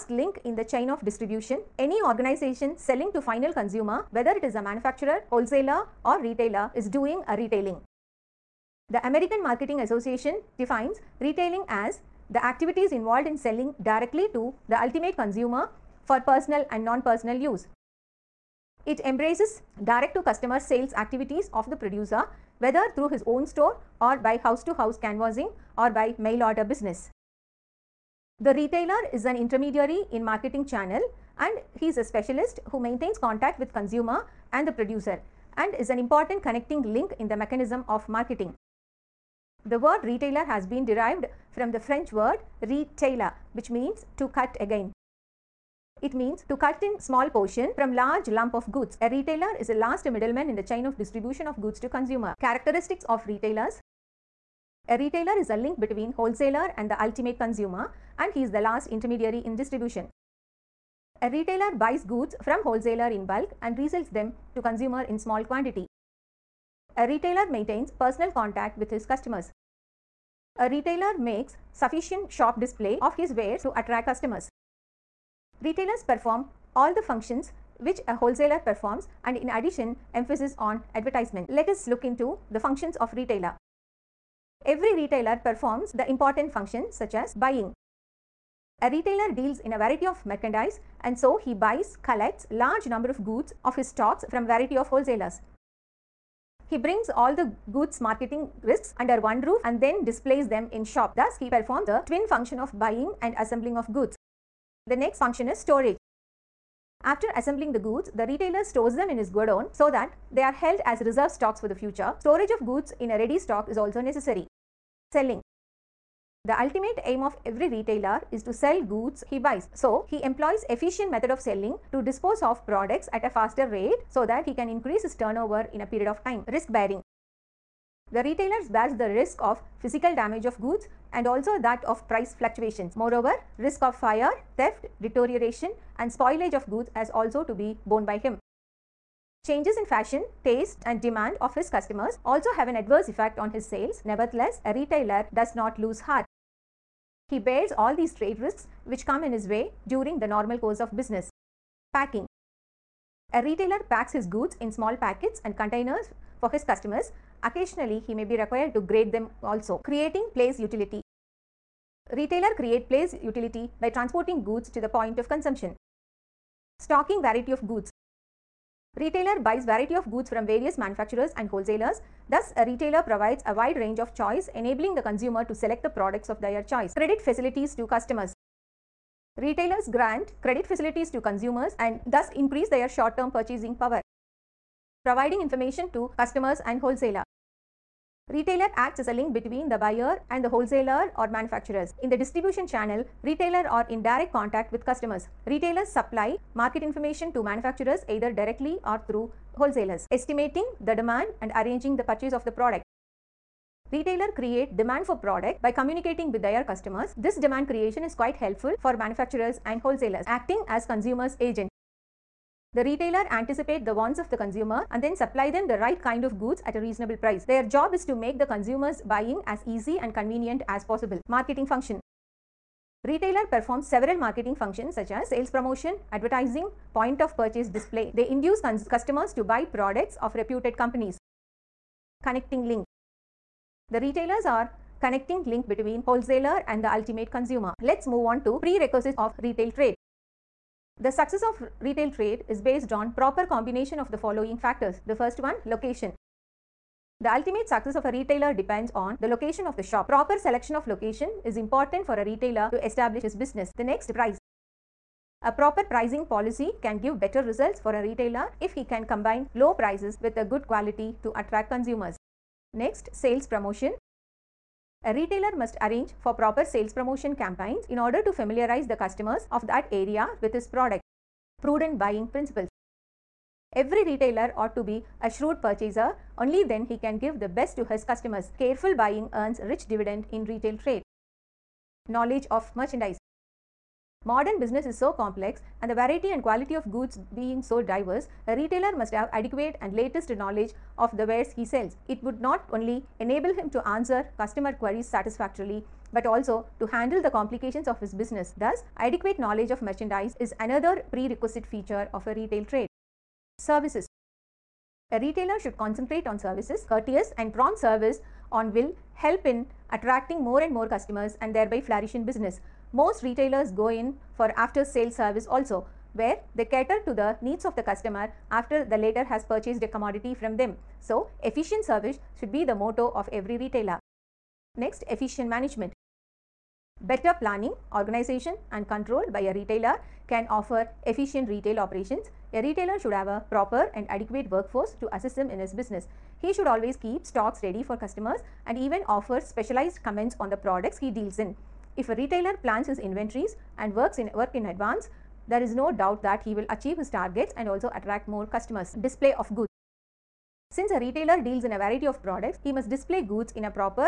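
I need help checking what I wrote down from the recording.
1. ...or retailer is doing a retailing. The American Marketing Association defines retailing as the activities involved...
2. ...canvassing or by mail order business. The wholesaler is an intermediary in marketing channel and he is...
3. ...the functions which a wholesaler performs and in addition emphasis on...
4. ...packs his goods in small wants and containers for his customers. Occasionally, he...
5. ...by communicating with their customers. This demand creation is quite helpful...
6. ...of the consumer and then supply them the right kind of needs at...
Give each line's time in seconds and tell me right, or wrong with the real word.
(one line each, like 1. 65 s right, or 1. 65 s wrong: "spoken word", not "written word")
1. 6 s right
2. 24 s wrong: "retailer", not "wholesaler"
3. 76 s right
4. 153 s wrong: "packets", not "wants"
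5. 205 s right
6. 214 s wrong: "goods", not "needs".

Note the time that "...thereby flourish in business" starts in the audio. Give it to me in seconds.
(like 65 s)
311 s.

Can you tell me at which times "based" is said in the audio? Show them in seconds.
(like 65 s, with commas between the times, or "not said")
242 s.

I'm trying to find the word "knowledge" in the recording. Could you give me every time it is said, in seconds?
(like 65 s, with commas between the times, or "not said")
282 s, 290 s, 299 s.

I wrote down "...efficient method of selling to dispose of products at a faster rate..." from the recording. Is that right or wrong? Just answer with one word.
right.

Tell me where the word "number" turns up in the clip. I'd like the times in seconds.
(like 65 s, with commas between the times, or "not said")
92 s.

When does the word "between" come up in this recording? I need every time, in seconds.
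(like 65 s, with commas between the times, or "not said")
55 s, 189 s, 235 s.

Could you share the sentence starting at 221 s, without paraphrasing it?
Marketing function Retailer performs several marketing functions such as sales promotion, advertising, point of purchase display.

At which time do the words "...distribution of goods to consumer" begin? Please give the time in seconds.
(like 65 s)
50 s.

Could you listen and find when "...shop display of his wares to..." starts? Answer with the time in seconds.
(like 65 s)
72 s.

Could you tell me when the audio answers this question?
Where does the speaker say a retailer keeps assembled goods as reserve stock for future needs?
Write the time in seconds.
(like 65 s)
109 s.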